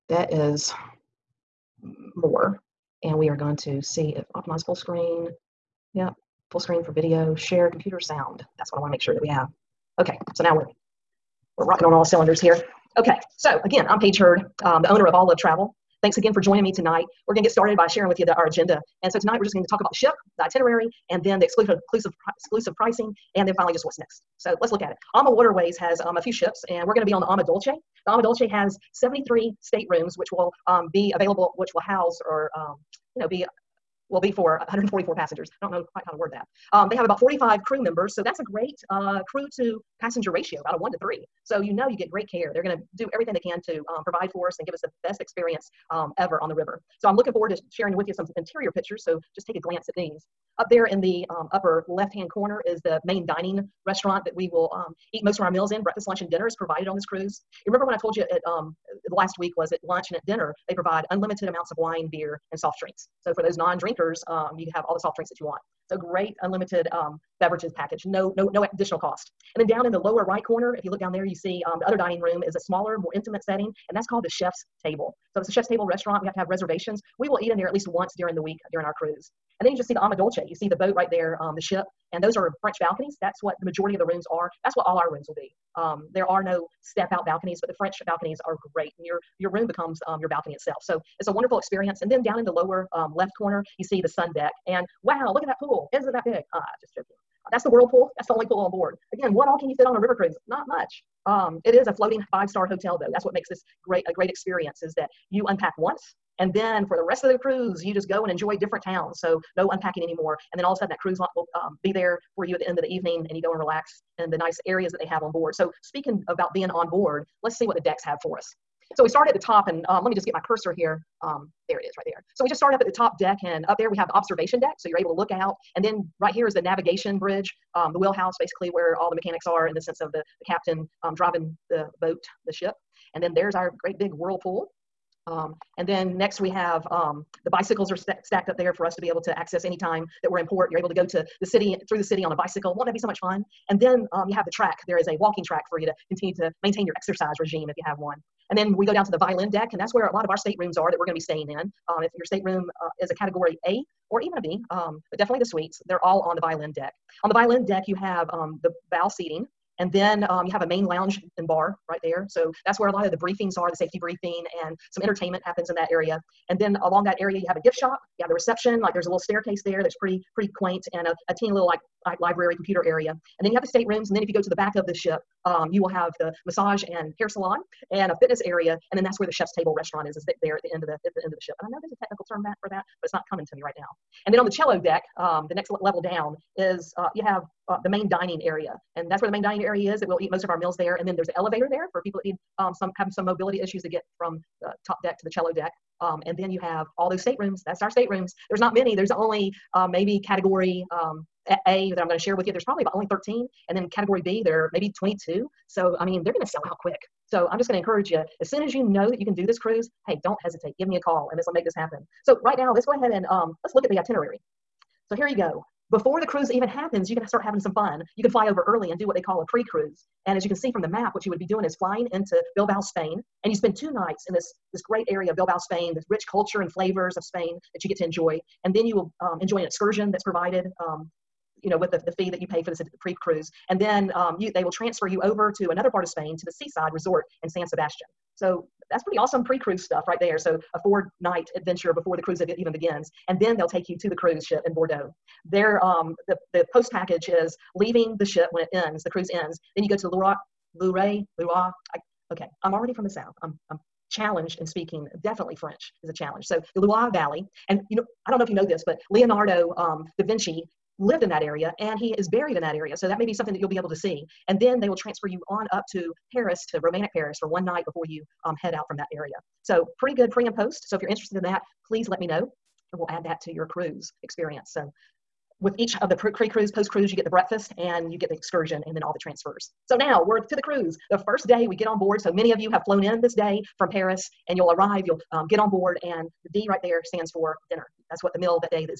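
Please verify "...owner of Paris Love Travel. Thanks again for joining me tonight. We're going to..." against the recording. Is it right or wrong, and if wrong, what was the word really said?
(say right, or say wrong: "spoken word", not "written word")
wrong: "All", not "Paris".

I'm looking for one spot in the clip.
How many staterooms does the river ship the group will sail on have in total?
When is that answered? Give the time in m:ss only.
0:28.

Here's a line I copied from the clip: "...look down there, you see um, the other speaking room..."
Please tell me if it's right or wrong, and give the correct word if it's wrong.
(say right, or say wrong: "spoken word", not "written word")
wrong: "dining", not "speaking".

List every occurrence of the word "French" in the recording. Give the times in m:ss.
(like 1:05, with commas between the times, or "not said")
1:22, 1:27, 4:15.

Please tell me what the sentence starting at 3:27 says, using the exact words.
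So, I'm just going to encourage you as soon as you know that you can do this cruise, hey, don't hesitate.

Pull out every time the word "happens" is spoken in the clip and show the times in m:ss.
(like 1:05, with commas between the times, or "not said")
2:45, 3:31, 3:36.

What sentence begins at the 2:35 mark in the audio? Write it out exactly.
They're all on the violin deck.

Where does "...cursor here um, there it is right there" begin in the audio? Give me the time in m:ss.
2:00.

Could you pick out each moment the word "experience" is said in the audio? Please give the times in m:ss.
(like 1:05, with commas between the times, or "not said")
0:45, 1:31, 1:44, 4:34.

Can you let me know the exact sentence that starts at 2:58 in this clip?
And then that's where the chef's table restaurant is, is there at the end of the, at the end of the ship.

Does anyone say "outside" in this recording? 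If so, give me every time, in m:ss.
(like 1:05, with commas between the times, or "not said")
not said.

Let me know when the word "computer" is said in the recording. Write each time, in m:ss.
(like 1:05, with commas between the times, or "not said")
0:07, 2:52.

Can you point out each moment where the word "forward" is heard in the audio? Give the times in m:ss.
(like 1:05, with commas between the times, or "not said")
0:47.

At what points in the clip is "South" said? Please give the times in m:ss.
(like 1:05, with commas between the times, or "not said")
4:13.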